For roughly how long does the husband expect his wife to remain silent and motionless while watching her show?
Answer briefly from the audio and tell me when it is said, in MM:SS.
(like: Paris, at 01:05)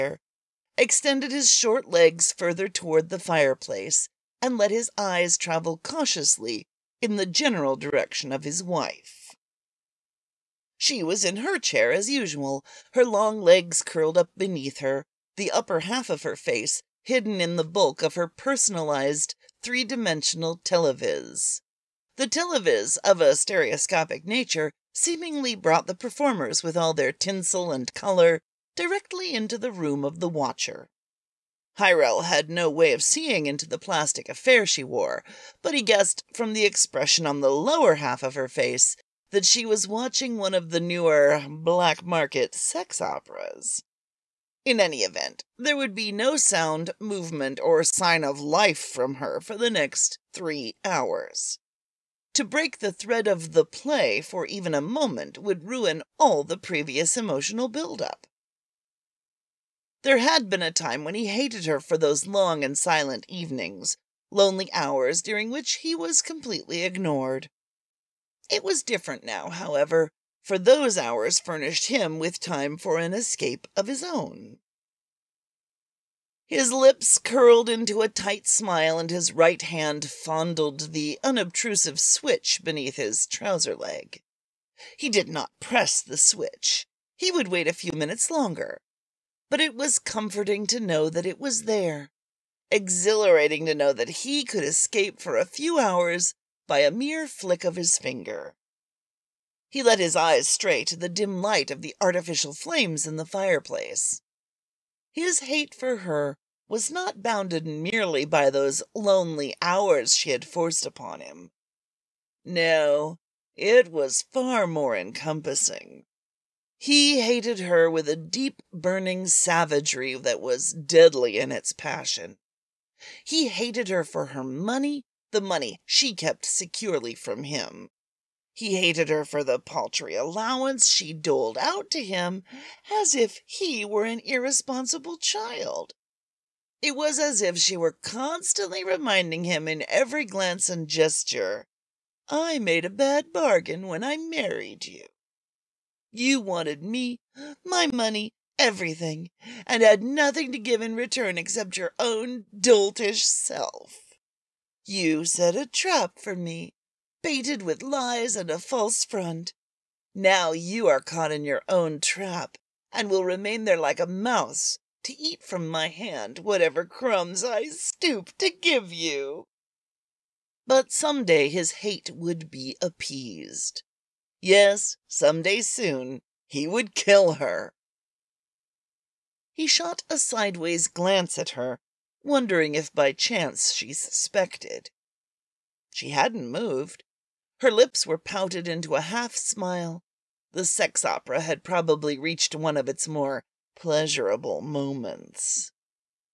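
3 hours, at 00:50.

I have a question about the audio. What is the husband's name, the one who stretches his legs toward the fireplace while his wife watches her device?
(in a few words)
Hyrel.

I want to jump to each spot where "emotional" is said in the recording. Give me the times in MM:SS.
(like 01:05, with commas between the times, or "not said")
00:57.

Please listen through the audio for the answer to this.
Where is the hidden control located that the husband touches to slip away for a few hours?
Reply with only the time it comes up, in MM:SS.
01:22.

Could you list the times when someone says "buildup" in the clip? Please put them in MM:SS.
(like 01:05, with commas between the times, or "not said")
00:57.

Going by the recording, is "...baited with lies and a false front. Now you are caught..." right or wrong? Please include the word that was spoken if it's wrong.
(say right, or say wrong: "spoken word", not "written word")
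right.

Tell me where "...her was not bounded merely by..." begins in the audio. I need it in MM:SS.
01:46.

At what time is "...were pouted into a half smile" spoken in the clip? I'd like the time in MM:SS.
03:08.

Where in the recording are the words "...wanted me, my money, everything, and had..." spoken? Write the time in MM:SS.
02:26.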